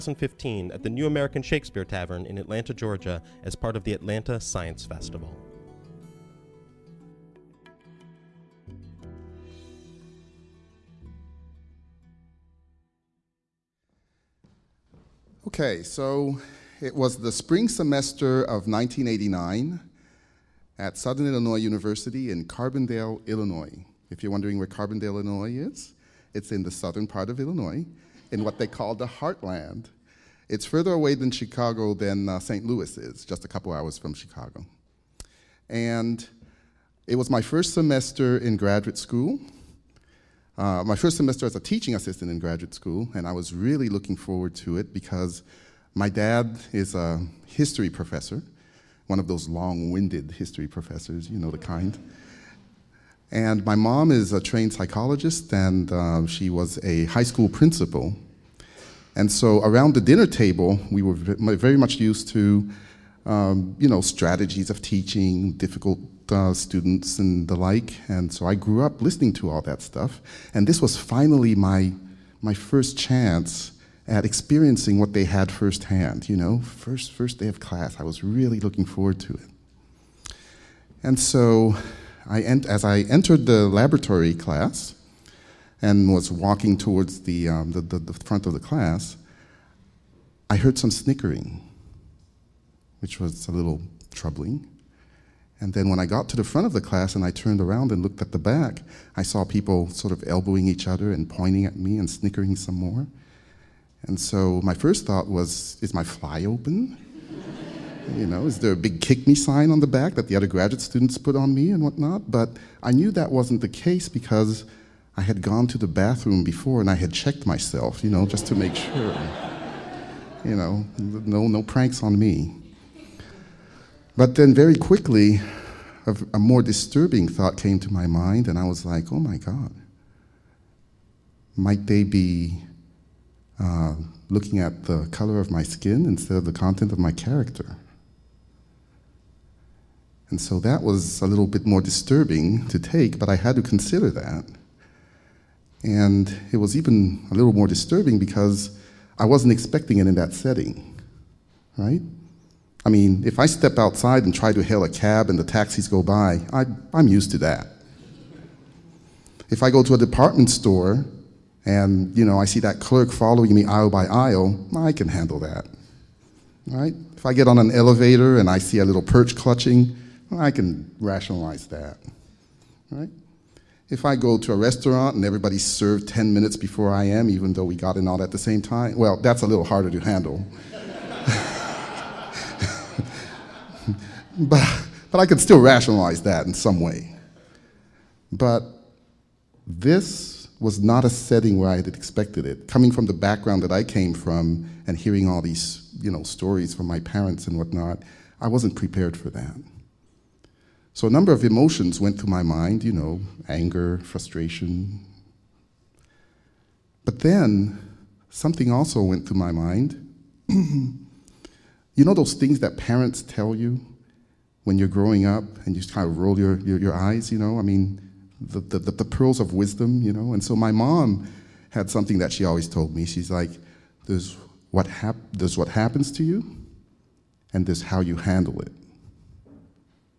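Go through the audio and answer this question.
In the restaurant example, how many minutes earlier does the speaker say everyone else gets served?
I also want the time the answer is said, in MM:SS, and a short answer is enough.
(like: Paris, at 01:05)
10, at 02:56.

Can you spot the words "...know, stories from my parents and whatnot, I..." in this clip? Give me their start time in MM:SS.
03:16.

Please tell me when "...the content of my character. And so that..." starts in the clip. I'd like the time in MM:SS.
02:16.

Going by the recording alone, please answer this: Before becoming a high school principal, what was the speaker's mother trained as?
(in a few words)
Psychologist.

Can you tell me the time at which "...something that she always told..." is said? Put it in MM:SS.
03:41.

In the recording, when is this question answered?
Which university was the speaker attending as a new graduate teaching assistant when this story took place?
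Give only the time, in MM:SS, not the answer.
00:20.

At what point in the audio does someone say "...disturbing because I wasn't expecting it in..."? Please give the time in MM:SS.
02:27.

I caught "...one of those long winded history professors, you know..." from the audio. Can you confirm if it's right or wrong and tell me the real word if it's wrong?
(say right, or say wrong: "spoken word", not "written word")
right.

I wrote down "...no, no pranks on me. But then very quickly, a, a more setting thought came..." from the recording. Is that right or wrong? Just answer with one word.
wrong.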